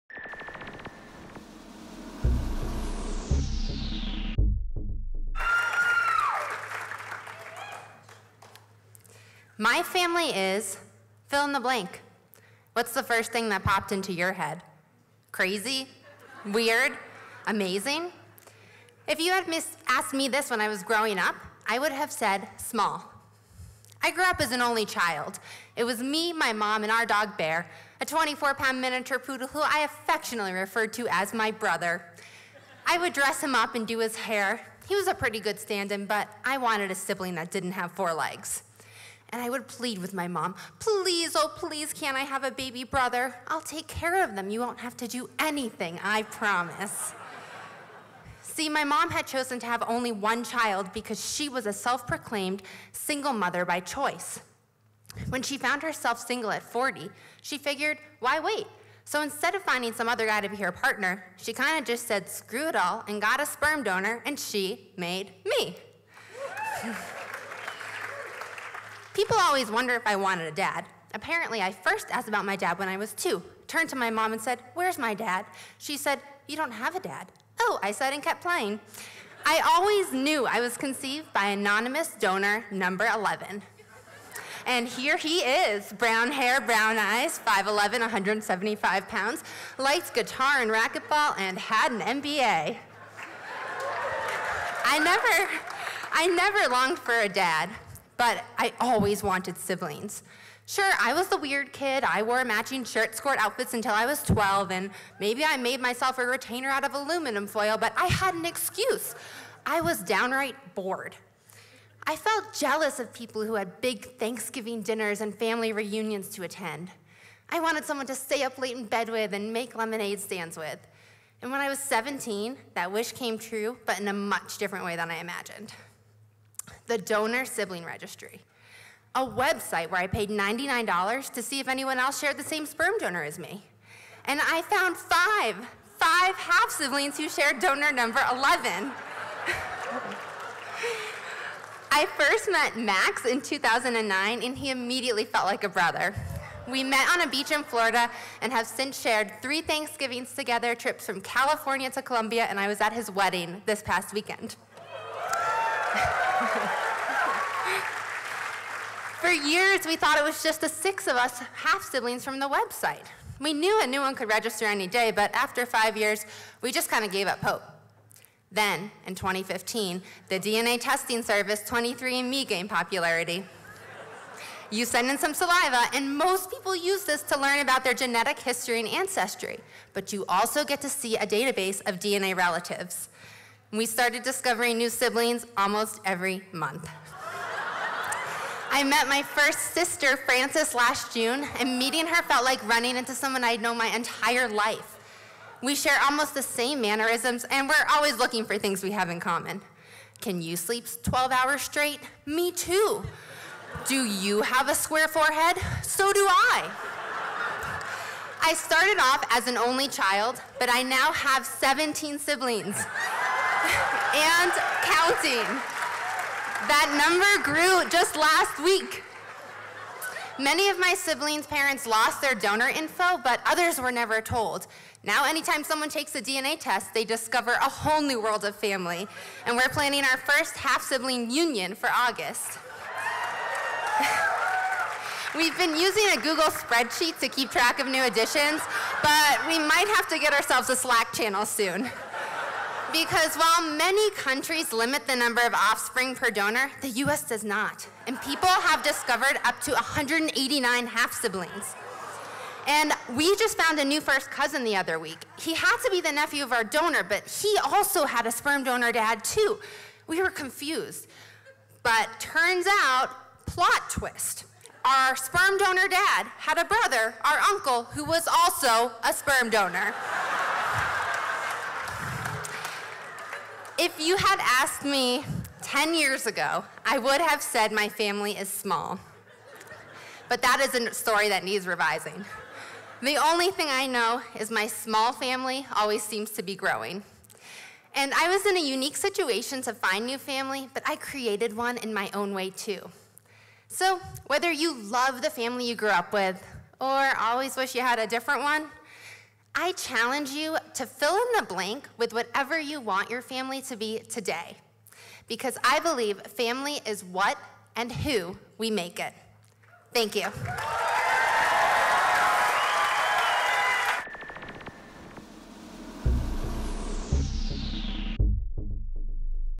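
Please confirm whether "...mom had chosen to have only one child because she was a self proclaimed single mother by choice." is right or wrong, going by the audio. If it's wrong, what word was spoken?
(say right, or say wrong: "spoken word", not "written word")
right.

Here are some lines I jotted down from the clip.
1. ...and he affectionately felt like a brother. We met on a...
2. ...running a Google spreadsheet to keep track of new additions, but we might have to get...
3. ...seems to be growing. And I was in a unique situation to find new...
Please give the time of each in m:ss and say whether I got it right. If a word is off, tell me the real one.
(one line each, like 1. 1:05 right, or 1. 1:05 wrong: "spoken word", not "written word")
1. 2:24 wrong: "immediately", not "affectionately"
2. 3:55 wrong: "using", not "running"
3. 4:46 right.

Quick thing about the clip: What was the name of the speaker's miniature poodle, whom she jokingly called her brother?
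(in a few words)
Bear.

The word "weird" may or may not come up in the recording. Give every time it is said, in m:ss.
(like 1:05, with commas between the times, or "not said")
0:16, 1:41.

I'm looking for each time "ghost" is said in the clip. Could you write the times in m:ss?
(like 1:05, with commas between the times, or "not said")
not said.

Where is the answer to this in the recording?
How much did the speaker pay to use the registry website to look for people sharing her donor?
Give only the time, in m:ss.
2:10.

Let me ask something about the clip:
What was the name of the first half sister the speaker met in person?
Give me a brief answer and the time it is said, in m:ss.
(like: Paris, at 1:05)
Frances, at 3:10.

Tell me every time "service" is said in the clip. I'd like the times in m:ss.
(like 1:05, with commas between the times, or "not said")
2:51.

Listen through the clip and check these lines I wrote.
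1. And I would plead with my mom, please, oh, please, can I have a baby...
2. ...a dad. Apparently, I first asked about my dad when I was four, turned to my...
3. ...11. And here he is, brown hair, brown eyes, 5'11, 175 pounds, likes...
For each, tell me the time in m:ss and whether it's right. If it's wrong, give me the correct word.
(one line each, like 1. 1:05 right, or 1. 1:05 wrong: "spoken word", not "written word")
1. 0:39 right
2. 1:10 wrong: "two", not "four"
3. 1:23 right.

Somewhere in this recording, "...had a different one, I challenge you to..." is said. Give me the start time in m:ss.
4:57.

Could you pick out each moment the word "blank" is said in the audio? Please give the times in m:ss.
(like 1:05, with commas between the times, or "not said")
0:11, 5:01.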